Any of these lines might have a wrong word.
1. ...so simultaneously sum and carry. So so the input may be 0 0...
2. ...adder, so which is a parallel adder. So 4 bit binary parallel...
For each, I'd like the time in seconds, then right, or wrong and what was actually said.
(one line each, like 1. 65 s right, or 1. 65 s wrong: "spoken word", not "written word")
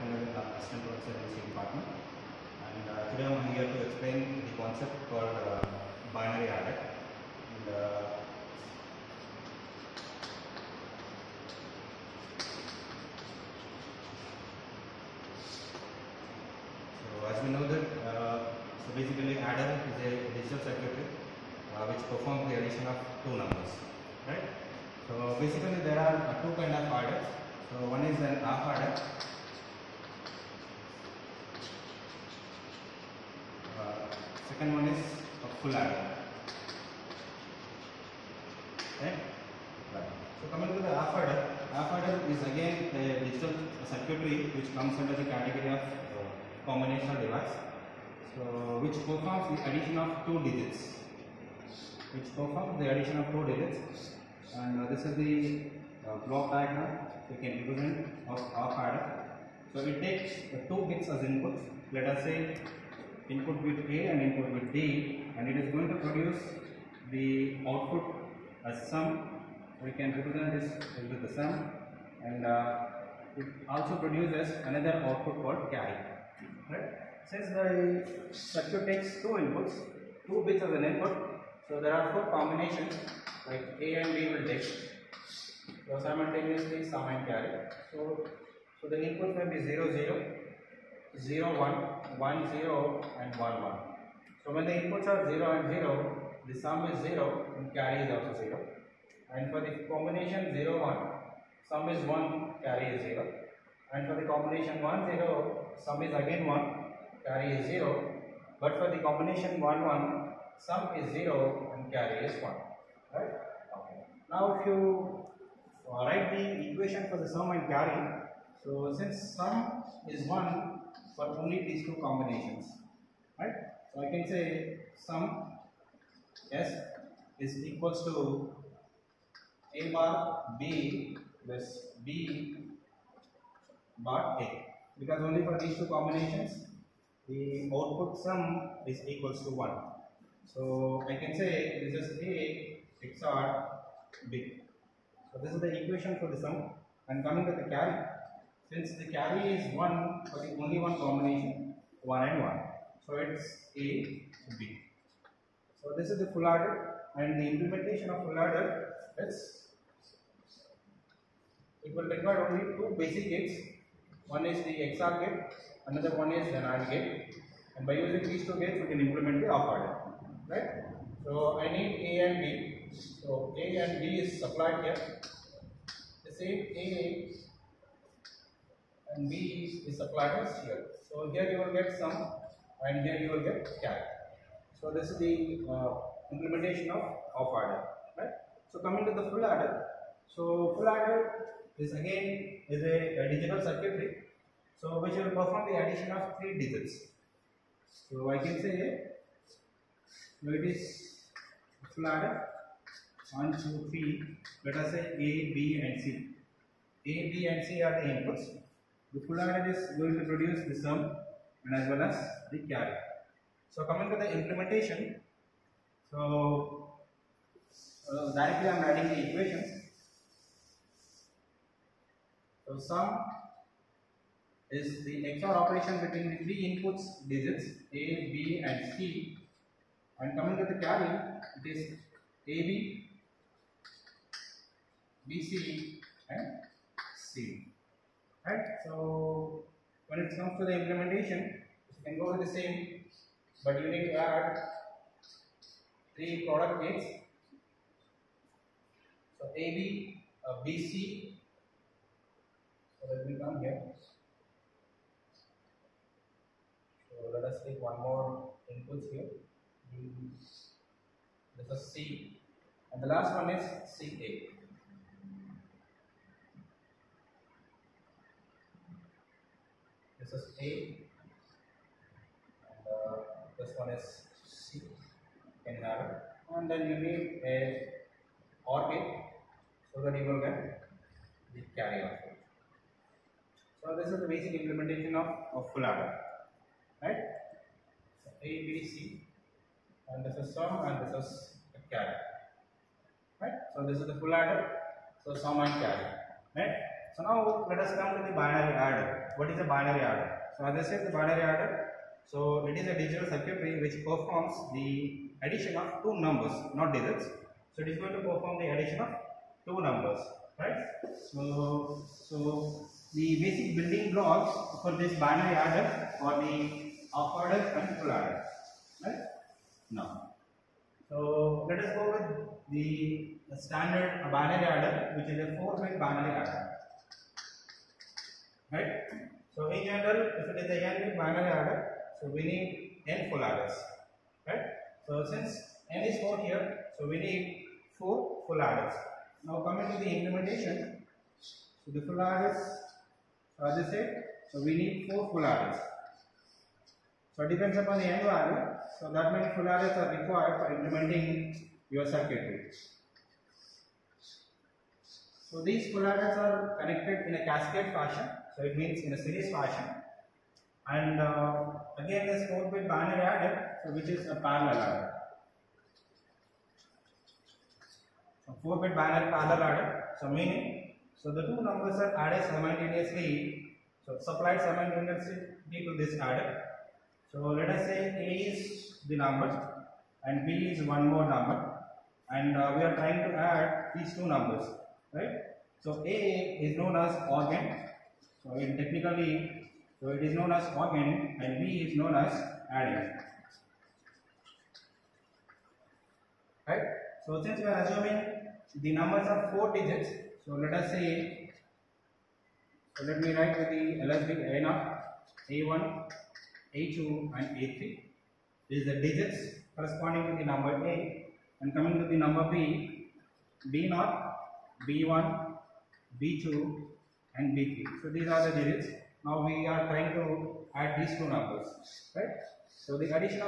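1. 85 s right
2. 363 s right.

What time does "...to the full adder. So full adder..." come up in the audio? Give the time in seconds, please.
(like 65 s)
189 s.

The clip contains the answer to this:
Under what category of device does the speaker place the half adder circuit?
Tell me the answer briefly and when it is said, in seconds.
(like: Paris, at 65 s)
combinational device, at 46 s.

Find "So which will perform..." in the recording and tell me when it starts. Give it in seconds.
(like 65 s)
194 s.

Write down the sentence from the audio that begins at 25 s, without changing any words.
So basically there are uh, two kind of adders.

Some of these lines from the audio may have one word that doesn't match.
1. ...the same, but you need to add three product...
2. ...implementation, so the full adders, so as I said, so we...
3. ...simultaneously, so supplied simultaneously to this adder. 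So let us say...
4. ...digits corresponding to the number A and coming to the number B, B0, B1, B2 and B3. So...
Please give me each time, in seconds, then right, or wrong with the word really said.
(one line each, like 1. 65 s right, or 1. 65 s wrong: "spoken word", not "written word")
1. 242 s right
2. 340 s right
3. 372 s right
4. 408 s right.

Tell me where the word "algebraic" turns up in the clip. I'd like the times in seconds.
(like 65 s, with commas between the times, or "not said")
404 s.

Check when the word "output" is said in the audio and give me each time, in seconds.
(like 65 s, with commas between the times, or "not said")
67 s, 75 s, 137 s, 282 s.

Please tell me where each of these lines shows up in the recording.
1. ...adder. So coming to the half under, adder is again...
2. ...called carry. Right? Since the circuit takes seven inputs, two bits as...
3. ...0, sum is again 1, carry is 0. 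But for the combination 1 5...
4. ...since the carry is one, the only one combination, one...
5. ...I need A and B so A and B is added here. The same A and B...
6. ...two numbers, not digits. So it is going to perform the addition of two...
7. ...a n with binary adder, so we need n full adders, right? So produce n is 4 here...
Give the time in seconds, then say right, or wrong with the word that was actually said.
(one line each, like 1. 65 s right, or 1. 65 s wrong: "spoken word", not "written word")
1. 35 s wrong: "adder", not "under"
2. 75 s wrong: "two", not "seven"
3. 105 s wrong: "1", not "5"
4. 148 s right
5. 171 s wrong: "supplied", not "added"
6. 306 s right
7. 330 s wrong: "since", not "produce".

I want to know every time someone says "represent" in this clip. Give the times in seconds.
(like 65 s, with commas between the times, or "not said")
57 s, 70 s.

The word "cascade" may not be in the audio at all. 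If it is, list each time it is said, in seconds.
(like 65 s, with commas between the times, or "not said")
357 s.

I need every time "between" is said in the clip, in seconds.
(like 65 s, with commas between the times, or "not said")
225 s.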